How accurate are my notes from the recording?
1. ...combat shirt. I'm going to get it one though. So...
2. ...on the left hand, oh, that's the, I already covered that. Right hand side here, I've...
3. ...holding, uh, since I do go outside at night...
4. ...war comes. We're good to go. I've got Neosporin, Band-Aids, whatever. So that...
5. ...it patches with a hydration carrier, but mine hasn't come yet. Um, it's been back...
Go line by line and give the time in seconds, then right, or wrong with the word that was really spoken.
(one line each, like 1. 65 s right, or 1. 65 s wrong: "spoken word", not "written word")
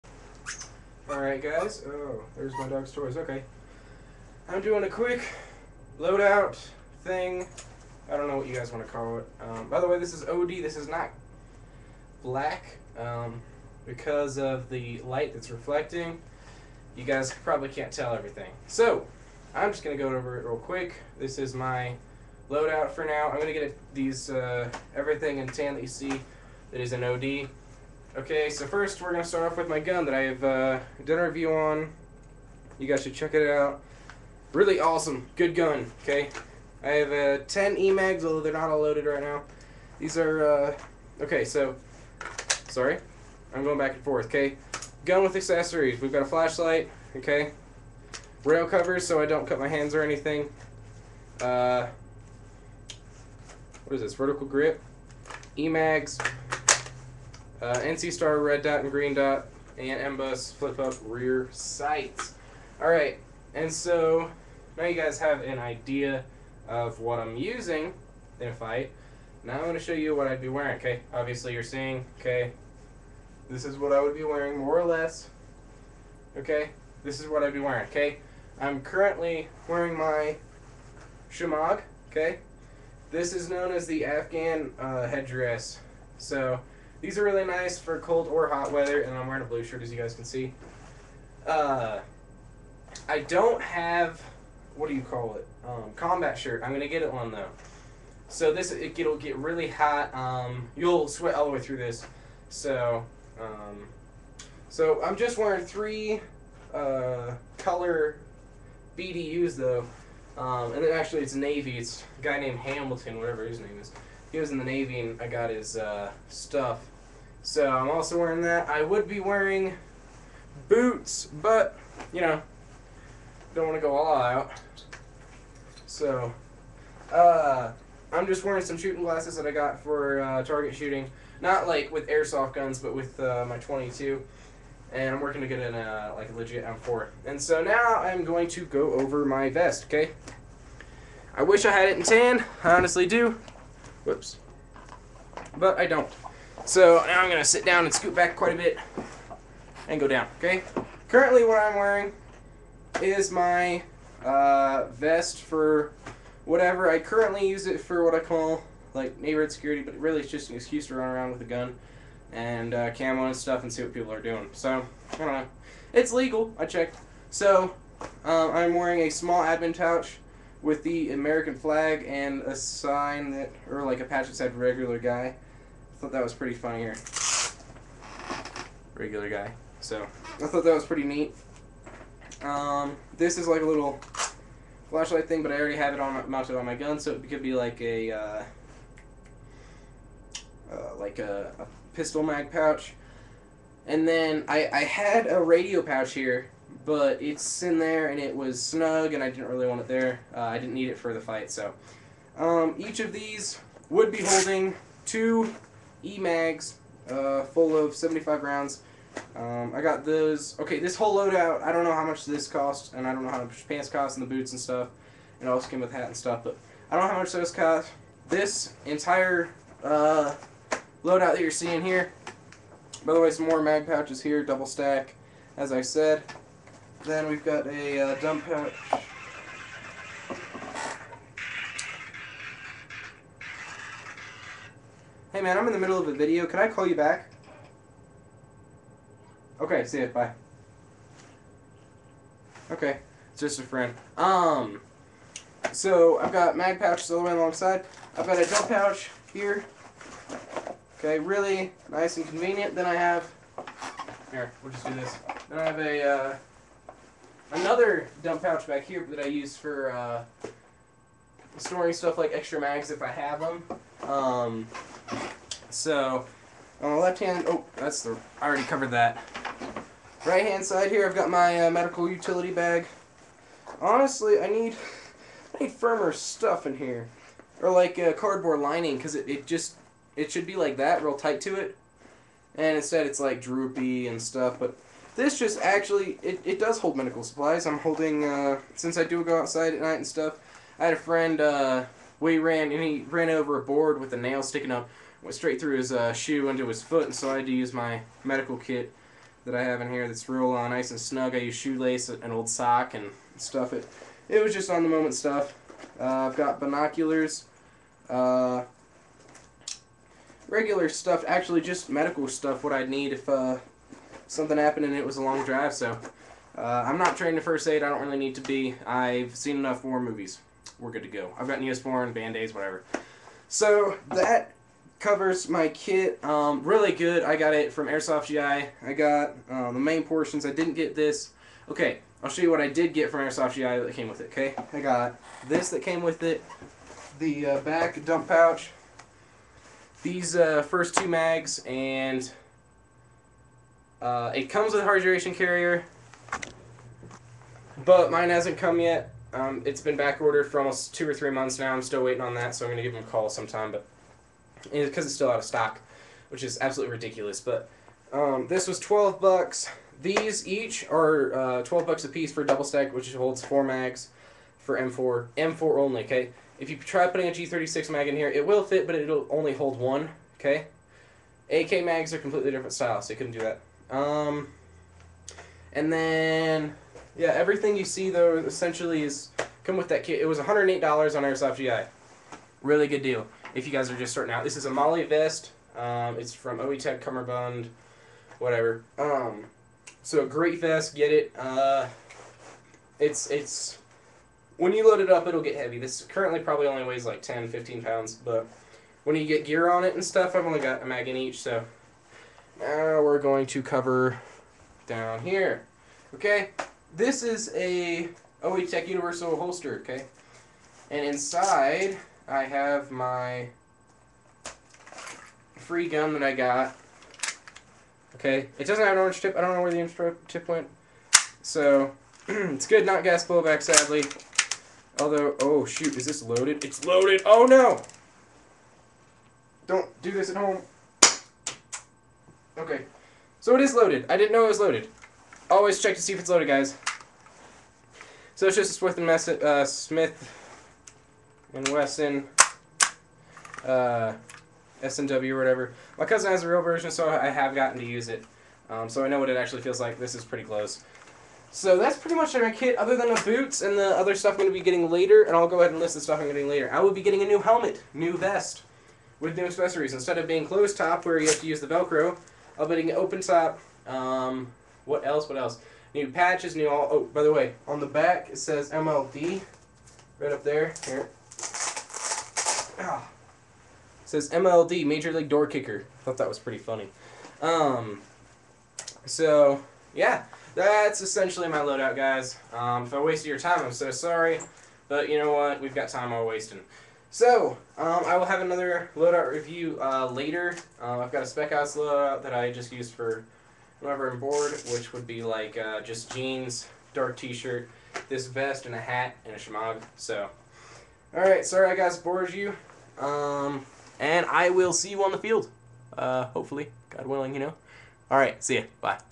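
1. 95 s right
2. 266 s right
3. 287 s right
4. 319 s wrong: "movies", not "comes"
5. 344 s wrong: "comes", not "patches".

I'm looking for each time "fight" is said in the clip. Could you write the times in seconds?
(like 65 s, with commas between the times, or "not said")
68 s, 201 s.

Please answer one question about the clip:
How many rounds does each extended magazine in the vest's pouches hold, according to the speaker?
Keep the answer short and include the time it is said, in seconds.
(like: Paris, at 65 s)
75, at 207 s.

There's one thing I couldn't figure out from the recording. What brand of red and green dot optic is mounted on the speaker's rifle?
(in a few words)
NC Star.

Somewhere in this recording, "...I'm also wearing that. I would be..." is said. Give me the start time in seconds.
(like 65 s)
117 s.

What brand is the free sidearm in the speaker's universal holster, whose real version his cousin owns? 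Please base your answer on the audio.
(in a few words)
Smith and Wesson.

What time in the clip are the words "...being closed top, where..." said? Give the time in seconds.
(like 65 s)
460 s.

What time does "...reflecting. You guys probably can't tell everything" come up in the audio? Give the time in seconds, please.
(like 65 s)
15 s.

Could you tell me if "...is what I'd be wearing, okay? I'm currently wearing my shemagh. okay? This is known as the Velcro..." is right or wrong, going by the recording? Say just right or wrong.
wrong.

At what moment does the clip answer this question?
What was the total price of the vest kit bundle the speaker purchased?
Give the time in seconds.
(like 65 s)
380 s.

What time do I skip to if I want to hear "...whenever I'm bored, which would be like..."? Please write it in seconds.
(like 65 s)
493 s.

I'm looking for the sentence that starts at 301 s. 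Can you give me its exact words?
I use shoelace, an old sock, and stuff it.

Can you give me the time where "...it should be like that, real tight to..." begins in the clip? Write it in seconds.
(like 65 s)
280 s.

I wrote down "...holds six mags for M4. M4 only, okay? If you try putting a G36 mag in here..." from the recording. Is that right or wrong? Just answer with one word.
wrong.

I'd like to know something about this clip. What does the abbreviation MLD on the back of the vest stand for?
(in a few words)
Major League Door Kicker.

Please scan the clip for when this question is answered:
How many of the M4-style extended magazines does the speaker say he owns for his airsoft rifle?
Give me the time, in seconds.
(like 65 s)
37 s.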